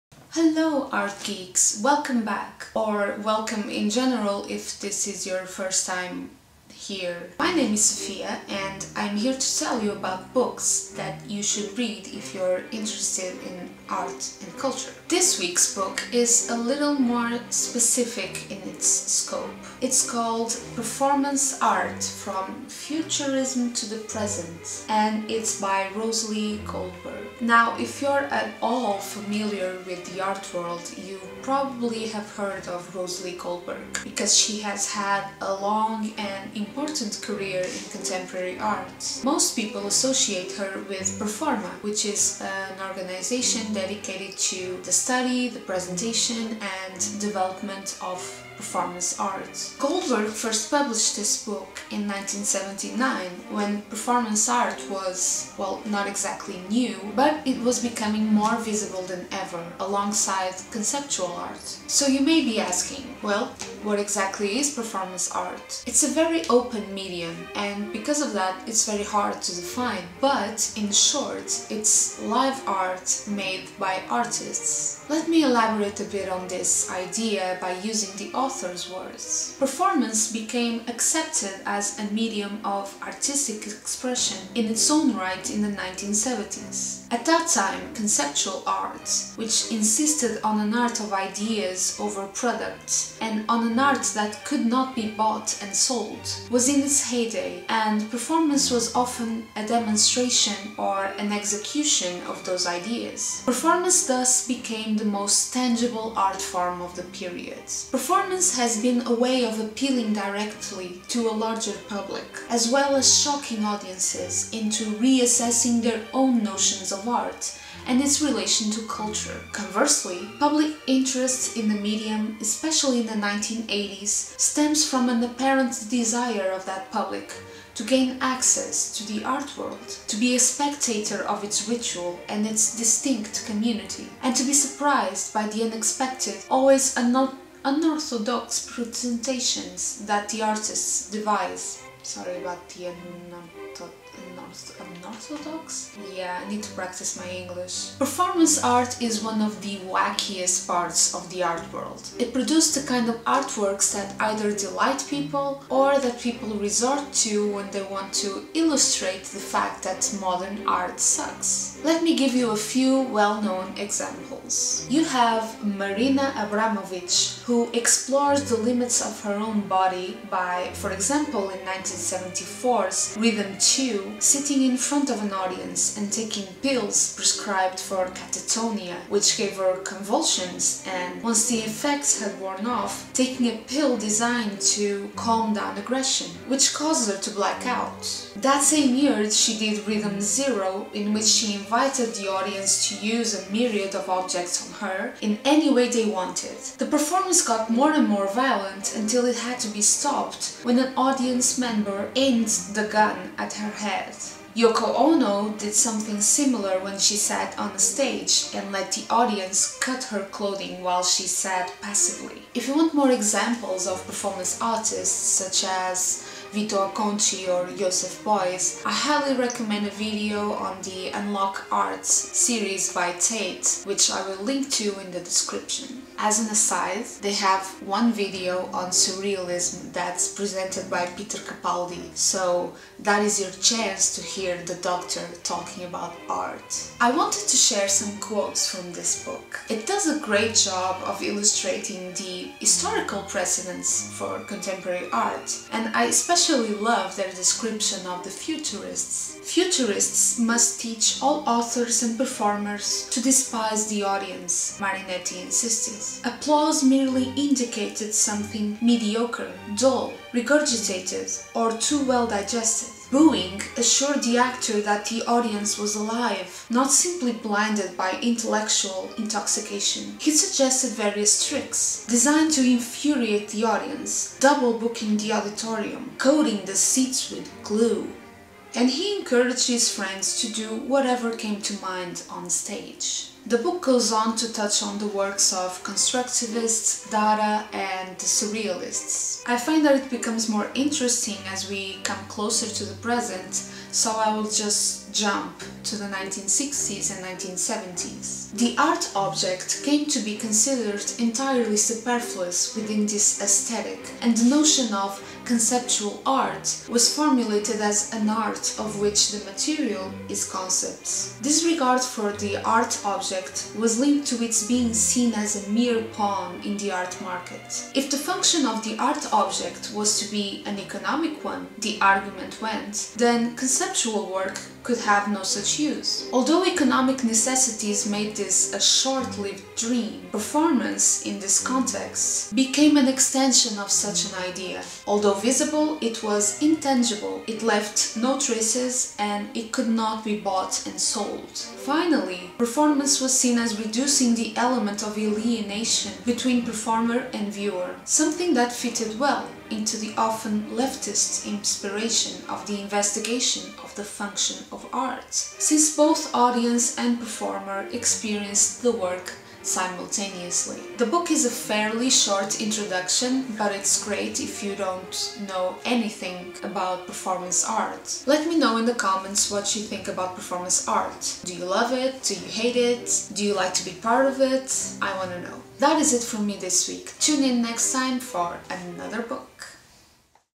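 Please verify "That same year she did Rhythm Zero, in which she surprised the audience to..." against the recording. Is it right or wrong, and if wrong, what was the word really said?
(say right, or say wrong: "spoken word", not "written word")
wrong: "invited", not "surprised".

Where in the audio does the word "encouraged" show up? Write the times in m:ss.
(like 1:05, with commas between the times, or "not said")
4:39.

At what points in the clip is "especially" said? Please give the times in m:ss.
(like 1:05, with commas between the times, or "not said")
2:02, 4:06.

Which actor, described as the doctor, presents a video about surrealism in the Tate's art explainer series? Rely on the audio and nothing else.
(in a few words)
Peter Capaldi.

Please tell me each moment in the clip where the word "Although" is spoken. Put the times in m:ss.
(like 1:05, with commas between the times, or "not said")
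5:26, 5:35.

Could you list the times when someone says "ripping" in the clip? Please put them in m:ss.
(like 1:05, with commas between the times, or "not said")
not said.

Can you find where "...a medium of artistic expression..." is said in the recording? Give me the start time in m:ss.
1:22.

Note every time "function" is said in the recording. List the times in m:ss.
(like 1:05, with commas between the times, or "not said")
5:18, 5:54.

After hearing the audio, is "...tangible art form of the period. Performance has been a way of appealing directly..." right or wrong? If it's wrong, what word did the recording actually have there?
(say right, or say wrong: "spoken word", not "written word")
right.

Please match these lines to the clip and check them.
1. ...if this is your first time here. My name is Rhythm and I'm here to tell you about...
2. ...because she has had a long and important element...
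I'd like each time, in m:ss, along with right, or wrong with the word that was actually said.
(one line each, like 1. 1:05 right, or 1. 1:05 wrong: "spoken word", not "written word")
1. 0:04 wrong: "Sofia", not "Rhythm"
2. 0:34 wrong: "important", not "element".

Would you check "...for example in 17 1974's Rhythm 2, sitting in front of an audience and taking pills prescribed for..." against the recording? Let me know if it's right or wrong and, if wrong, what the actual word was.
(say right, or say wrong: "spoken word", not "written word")
wrong: "19", not "17".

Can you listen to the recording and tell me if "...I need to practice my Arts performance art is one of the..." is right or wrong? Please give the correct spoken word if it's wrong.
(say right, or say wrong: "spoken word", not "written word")
wrong: "English", not "Arts".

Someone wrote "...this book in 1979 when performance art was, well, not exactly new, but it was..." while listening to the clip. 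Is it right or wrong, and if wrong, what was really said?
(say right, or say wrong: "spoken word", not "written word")
right.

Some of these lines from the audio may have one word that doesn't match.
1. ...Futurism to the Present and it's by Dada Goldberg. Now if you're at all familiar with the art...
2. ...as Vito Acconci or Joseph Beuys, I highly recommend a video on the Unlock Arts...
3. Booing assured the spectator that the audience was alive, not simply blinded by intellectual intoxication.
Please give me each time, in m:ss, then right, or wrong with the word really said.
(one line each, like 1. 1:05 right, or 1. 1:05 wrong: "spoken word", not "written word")
1. 0:22 wrong: "Roselee", not "Dada"
2. 3:35 right
3. 4:23 wrong: "actor", not "spectator".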